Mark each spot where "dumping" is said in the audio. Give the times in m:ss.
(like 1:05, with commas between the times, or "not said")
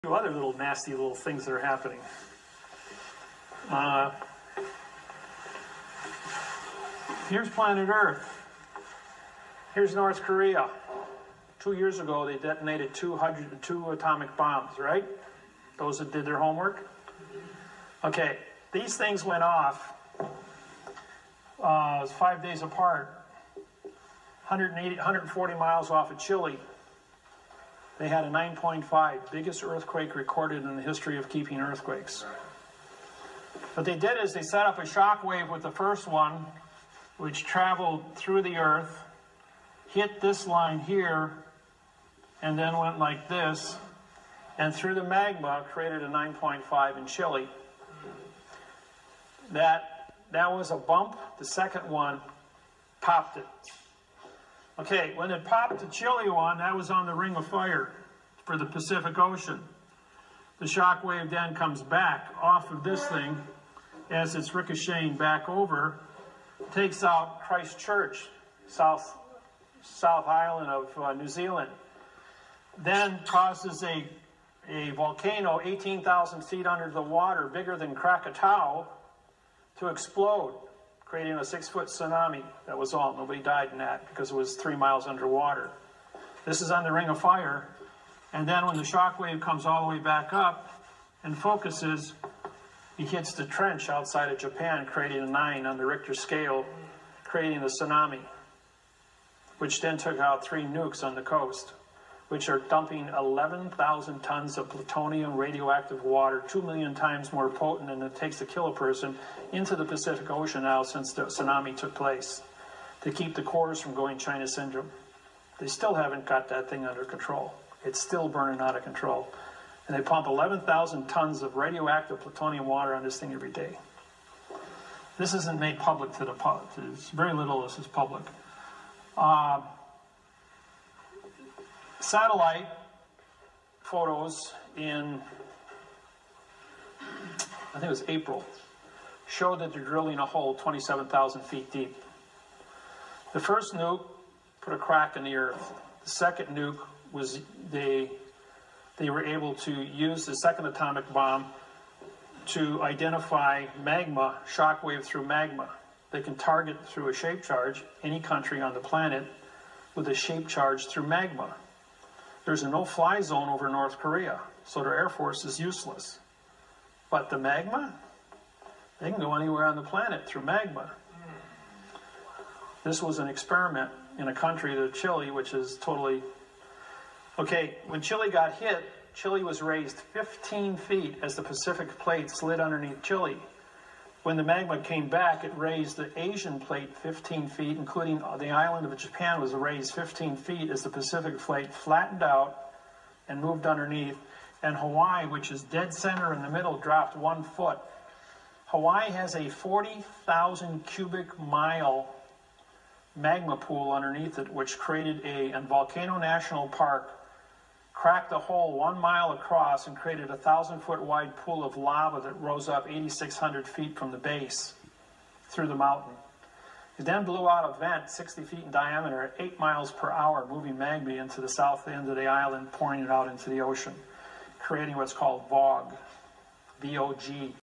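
1:42.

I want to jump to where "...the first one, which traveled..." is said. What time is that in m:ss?
0:35.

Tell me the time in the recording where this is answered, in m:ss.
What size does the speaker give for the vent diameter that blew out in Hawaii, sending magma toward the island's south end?
3:38.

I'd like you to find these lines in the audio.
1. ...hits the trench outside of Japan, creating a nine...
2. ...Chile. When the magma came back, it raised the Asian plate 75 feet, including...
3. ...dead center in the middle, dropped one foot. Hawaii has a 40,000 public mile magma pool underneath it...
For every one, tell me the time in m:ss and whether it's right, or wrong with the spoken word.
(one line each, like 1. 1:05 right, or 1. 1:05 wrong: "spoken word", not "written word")
1. 1:33 right
2. 3:03 wrong: "15", not "75"
3. 3:15 wrong: "cubic", not "public".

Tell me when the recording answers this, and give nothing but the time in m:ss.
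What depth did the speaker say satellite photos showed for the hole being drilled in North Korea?
2:20.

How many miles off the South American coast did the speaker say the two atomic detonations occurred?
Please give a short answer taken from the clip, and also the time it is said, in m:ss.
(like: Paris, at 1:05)
140 miles, at 0:24.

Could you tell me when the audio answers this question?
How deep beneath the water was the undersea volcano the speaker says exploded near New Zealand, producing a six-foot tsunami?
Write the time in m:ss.
1:15.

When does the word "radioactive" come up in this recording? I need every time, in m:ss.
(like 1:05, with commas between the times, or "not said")
1:45, 2:01.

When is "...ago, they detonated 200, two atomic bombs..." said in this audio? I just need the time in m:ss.
0:11.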